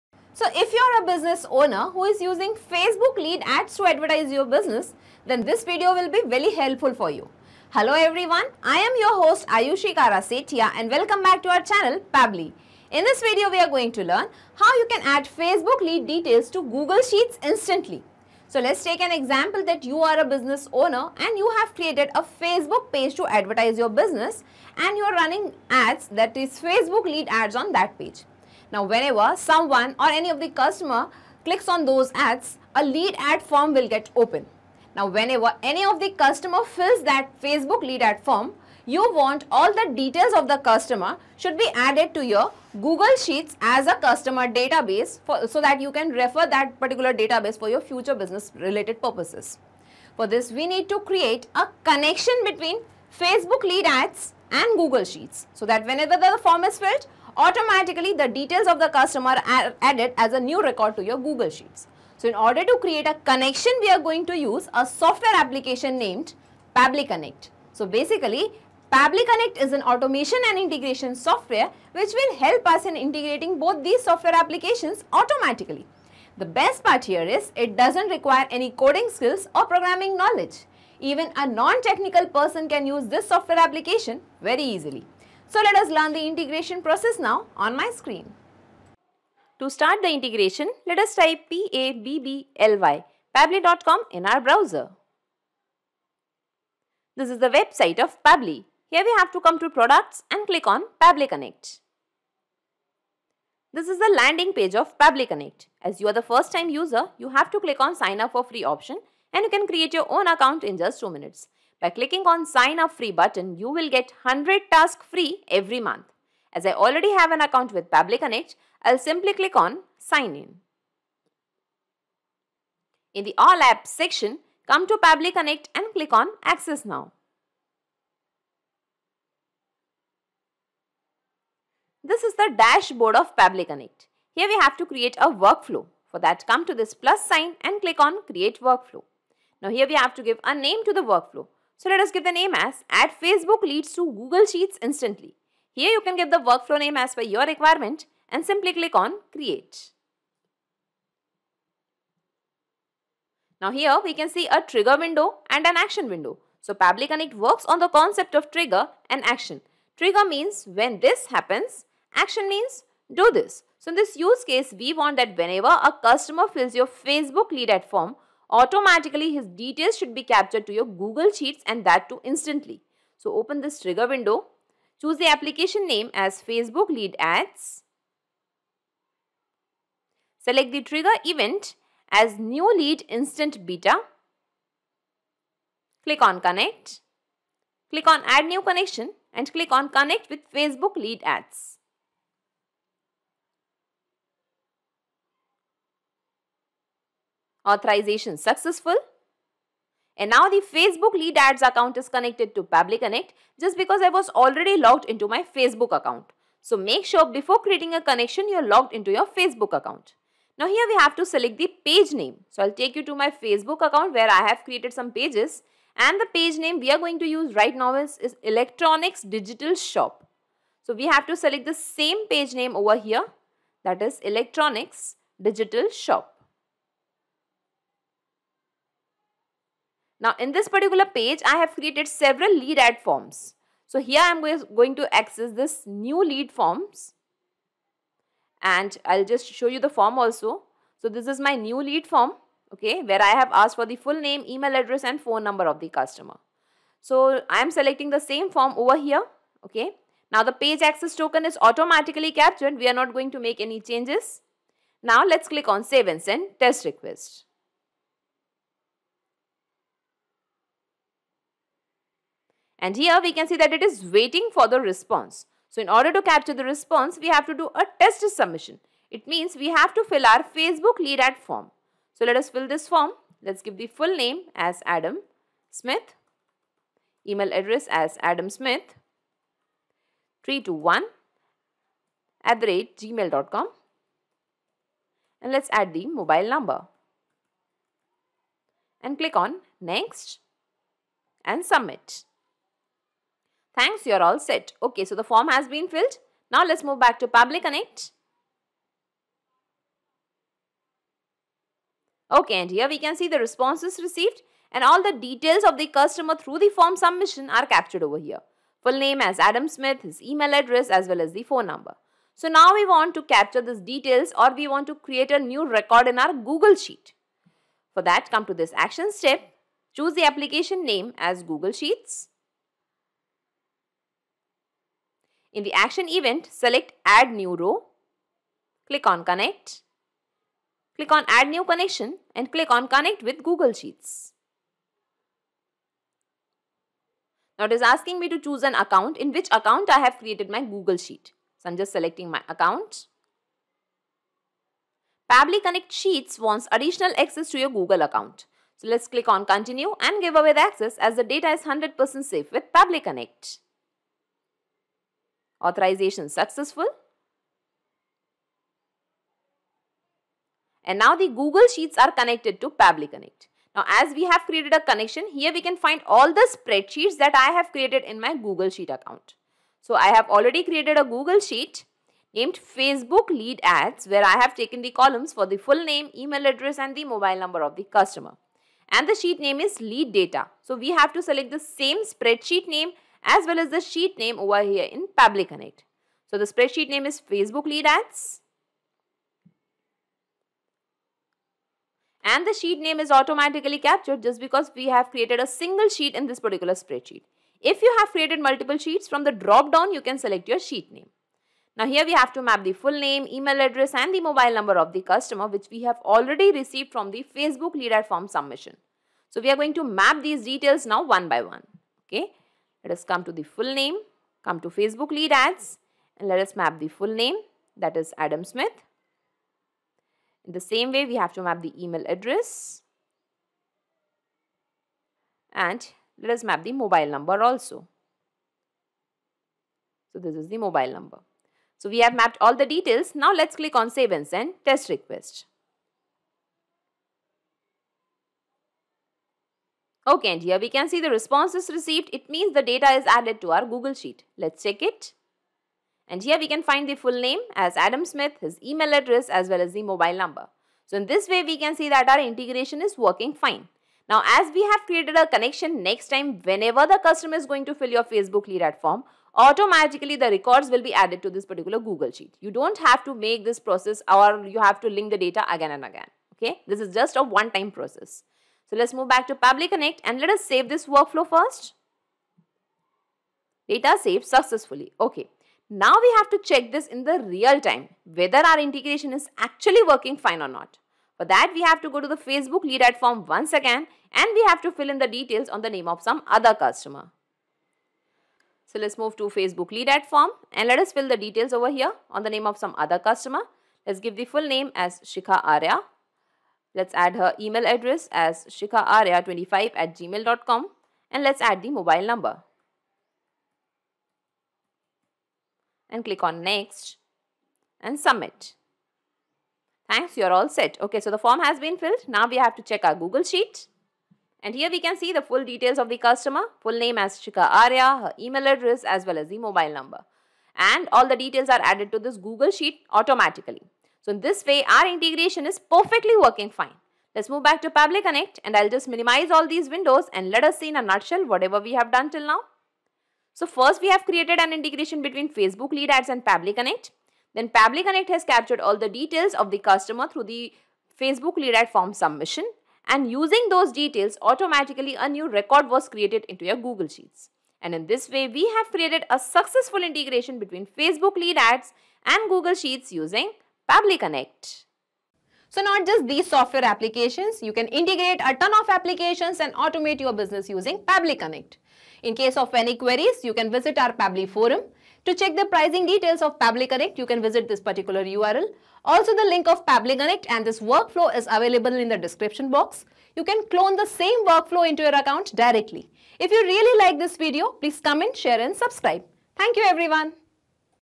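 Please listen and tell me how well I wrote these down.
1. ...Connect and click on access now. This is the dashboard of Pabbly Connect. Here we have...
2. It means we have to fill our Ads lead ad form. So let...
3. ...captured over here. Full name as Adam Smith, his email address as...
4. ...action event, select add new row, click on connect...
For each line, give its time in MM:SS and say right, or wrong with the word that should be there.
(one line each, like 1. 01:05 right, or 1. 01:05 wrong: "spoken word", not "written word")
1. 02:05 right
2. 04:29 wrong: "Facebook", not "Ads"
3. 05:07 right
4. 05:25 right.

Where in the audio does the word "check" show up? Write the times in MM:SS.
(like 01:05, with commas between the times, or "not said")
07:24, 07:56, 08:32, 09:25.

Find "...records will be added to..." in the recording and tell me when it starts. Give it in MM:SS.
07:40.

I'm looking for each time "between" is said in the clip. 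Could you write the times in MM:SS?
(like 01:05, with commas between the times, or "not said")
00:52, 08:55, 09:10.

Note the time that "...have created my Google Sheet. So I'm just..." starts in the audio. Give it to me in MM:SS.
05:39.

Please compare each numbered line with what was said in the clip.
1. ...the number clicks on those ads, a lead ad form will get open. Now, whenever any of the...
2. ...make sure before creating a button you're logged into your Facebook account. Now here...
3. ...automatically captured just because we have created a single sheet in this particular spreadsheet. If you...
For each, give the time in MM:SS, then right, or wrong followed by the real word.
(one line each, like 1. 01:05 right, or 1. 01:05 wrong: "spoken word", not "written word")
1. 00:30 wrong: "customer", not "number"
2. 03:26 wrong: "connection", not "button"
3. 06:33 right.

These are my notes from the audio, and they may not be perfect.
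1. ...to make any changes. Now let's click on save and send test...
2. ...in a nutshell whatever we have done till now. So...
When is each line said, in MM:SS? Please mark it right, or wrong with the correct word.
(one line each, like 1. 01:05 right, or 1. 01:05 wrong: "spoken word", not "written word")
1. 04:13 right
2. 08:50 right.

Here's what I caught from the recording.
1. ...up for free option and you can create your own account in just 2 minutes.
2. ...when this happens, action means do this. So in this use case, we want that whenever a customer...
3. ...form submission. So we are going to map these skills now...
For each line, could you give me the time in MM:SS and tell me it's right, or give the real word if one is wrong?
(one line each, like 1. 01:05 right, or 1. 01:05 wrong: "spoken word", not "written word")
1. 01:48 right
2. 02:40 right
3. 06:48 wrong: "details", not "skills".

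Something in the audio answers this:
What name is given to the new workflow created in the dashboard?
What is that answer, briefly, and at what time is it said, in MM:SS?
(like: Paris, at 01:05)
Add Facebook leads to Google Sheets instantly, at 02:22.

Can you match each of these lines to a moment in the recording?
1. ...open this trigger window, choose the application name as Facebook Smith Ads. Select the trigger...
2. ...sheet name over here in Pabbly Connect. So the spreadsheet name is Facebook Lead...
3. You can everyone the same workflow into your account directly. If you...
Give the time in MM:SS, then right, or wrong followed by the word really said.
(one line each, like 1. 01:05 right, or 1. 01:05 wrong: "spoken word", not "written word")
1. 02:53 wrong: "Lead", not "Smith"
2. 06:23 right
3. 09:33 wrong: "clone", not "everyone".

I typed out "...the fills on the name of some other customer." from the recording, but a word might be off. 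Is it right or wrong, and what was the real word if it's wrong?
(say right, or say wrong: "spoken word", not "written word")
wrong: "details", not "fills".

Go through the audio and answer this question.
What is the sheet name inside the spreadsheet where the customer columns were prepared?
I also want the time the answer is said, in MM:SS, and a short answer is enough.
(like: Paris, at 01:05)
Lead Data, at 06:19.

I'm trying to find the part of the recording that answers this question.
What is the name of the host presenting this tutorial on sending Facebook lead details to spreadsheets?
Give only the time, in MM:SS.
00:09.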